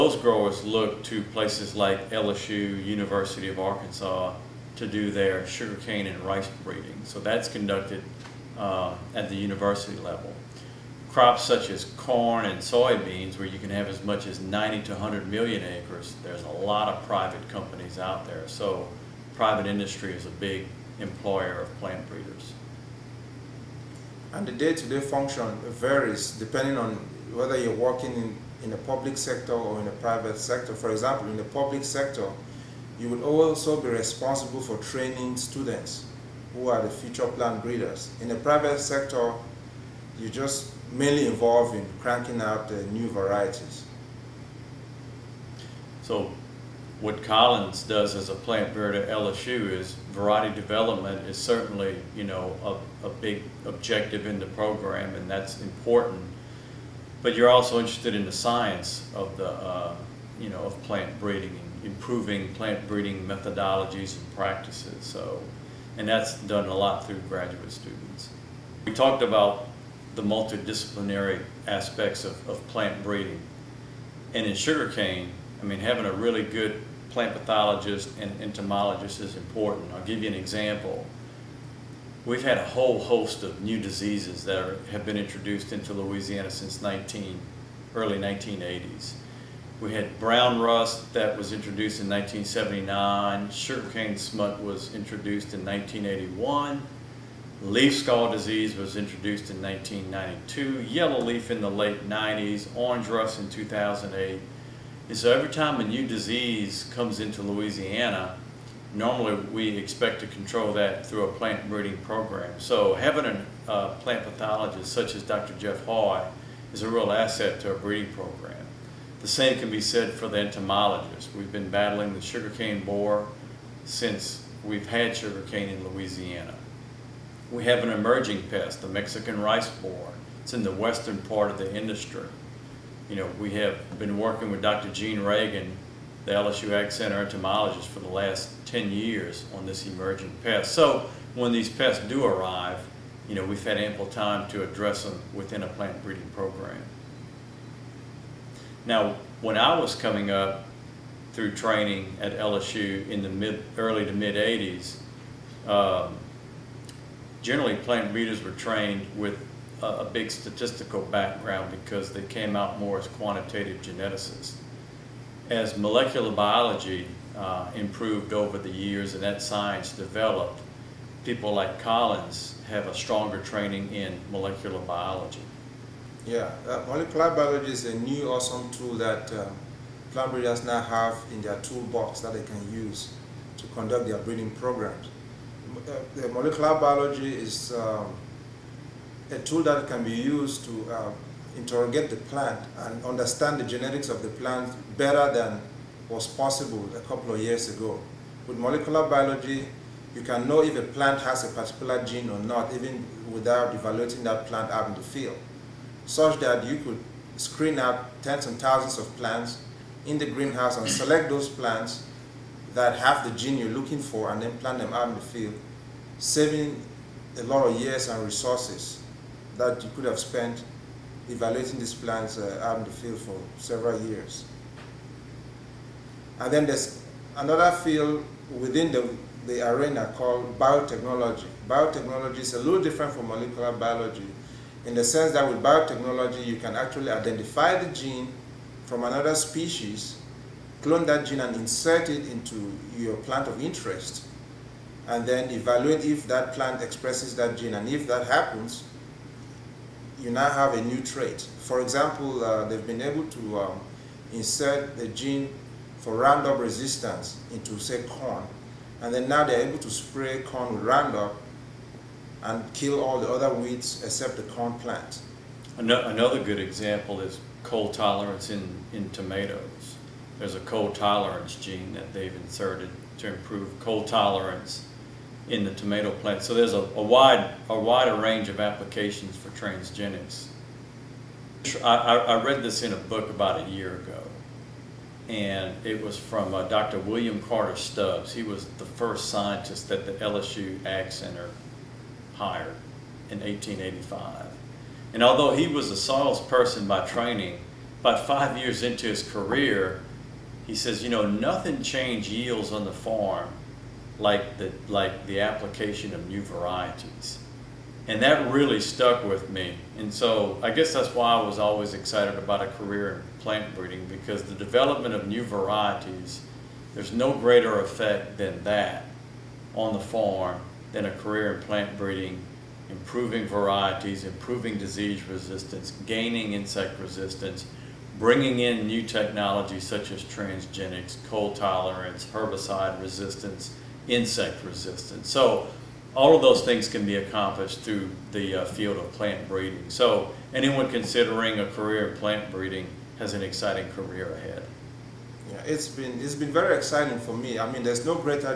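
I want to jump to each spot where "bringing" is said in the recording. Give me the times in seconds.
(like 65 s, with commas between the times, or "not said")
328 s.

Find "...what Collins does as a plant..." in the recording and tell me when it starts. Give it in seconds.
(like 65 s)
46 s.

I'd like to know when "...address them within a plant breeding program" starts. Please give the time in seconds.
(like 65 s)
144 s.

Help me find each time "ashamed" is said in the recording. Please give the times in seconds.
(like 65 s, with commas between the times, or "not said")
not said.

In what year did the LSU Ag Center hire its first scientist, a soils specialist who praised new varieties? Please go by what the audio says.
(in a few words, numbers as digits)
1885.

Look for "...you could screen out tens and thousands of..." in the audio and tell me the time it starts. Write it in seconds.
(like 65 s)
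206 s.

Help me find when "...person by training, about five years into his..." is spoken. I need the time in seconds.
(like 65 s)
296 s.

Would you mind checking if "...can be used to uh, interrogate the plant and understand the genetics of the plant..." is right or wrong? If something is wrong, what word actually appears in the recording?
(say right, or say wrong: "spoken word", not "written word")
right.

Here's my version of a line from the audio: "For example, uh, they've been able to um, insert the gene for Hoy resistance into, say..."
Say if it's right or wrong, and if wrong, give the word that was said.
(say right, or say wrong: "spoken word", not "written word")
wrong: "Roundup", not "Hoy".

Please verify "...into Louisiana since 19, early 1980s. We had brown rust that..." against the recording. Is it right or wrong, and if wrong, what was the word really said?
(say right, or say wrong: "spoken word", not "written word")
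right.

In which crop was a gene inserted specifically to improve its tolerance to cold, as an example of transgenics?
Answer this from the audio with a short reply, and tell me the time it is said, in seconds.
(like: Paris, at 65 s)
Tomatoes, at 269 s.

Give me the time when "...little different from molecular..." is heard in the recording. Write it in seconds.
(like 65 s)
232 s.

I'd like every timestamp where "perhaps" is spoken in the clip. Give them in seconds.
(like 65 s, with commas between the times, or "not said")
not said.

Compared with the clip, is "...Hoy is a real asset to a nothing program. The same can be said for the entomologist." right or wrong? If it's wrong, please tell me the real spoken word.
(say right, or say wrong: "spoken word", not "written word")
wrong: "breeding", not "nothing".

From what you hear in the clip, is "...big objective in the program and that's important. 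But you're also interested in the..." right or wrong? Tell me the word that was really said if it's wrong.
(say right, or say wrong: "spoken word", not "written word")
right.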